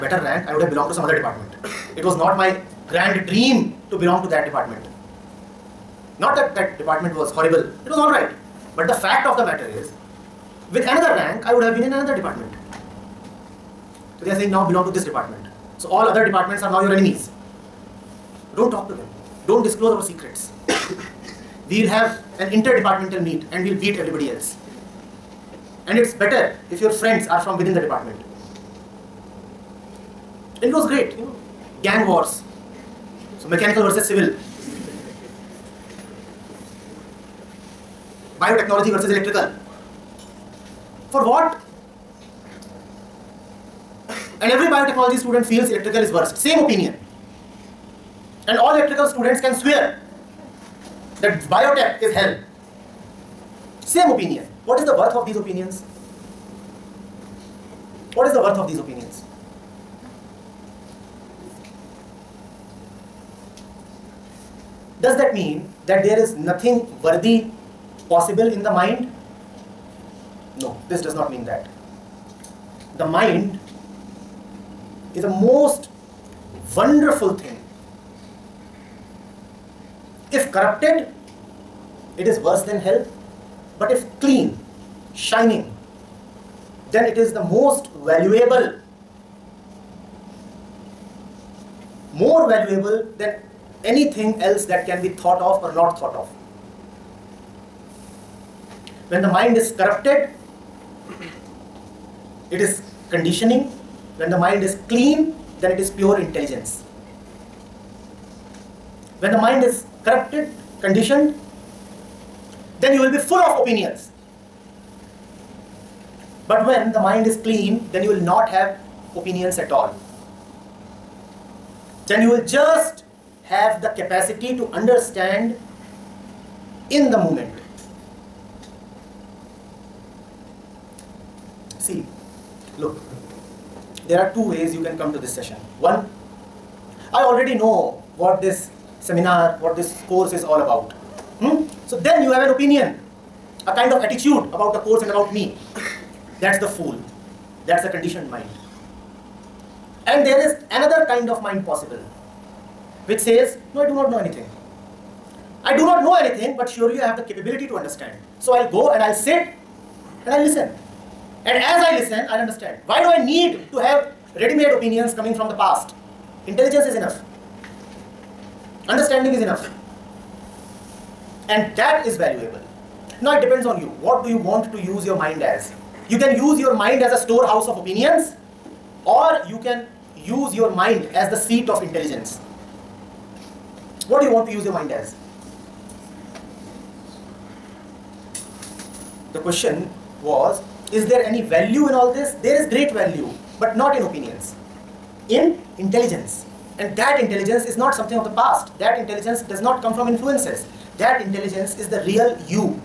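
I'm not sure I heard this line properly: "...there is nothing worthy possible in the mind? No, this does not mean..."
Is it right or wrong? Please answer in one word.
right.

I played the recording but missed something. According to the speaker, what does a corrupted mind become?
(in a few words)
Conditioning.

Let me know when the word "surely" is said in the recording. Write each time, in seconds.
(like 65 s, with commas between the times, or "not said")
156 s.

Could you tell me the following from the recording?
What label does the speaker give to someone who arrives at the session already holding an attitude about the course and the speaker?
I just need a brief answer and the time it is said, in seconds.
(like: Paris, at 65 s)
The fool, at 146 s.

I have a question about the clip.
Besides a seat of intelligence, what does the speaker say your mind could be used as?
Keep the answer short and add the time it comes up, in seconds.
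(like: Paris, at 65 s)
A storehouse of opinions, at 177 s.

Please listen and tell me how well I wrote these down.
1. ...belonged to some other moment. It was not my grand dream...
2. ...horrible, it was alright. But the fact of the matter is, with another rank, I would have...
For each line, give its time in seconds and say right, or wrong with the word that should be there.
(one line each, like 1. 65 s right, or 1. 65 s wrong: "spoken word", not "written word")
1. 0 s wrong: "department", not "moment"
2. 7 s right.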